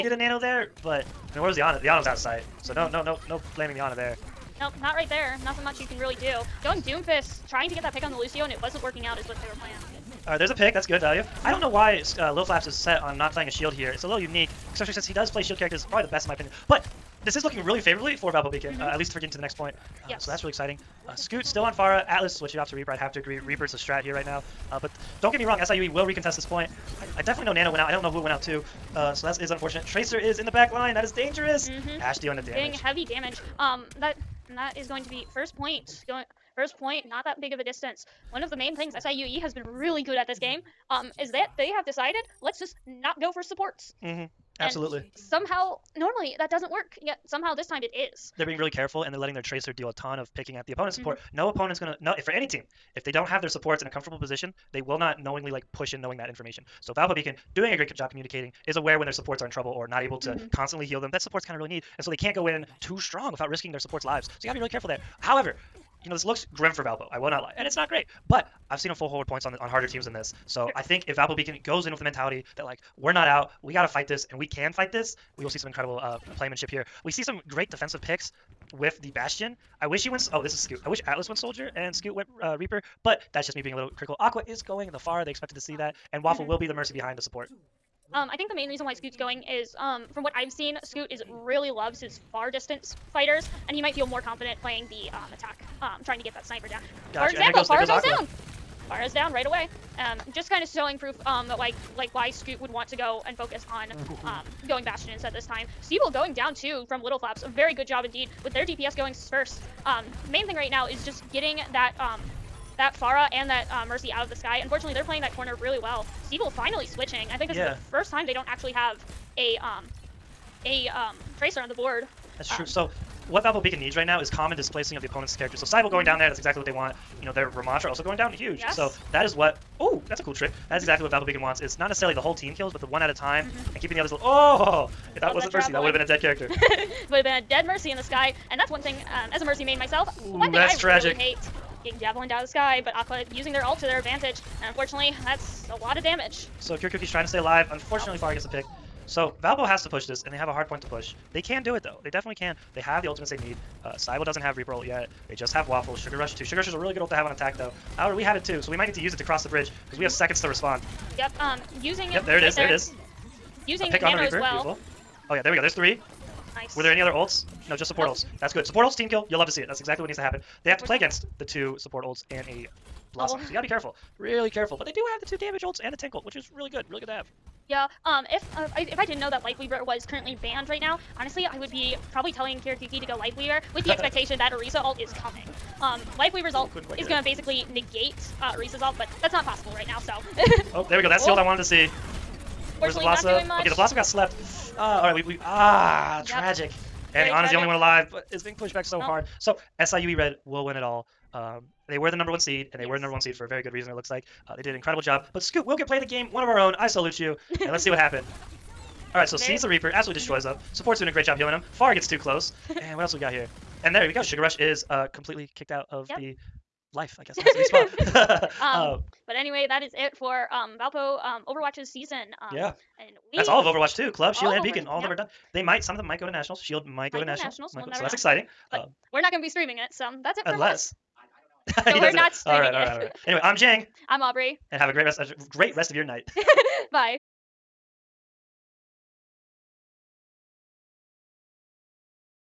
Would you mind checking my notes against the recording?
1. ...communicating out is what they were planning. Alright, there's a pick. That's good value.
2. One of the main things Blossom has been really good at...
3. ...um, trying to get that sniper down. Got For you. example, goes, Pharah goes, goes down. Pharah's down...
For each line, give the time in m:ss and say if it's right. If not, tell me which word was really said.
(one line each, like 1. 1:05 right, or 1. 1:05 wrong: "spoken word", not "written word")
1. 0:08 wrong: "working", not "communicating"
2. 0:38 wrong: "SIUE", not "Blossom"
3. 1:35 right.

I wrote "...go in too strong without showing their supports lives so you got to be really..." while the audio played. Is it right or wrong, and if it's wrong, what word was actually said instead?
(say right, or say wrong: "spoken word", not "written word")
wrong: "risking", not "showing".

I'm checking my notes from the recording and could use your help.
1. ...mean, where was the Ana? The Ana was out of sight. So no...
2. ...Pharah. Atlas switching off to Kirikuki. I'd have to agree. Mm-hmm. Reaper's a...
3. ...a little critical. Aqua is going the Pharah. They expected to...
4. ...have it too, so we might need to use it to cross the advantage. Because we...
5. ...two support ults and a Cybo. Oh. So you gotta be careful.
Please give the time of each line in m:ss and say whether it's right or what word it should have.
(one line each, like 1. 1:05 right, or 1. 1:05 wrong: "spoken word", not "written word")
1. 0:01 right
2. 0:21 wrong: "Reaper", not "Kirikuki"
3. 1:23 right
4. 2:38 wrong: "bridge", not "advantage"
5. 2:51 wrong: "Blossom", not "Cybo".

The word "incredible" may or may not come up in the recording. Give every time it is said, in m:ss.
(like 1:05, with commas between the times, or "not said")
1:15, 3:24.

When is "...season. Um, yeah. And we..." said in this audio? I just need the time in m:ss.
3:41.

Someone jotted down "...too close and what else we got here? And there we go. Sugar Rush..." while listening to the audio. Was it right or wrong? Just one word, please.
right.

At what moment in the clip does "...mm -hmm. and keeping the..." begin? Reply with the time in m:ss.
2:13.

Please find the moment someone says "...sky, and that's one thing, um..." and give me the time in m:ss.
2:18.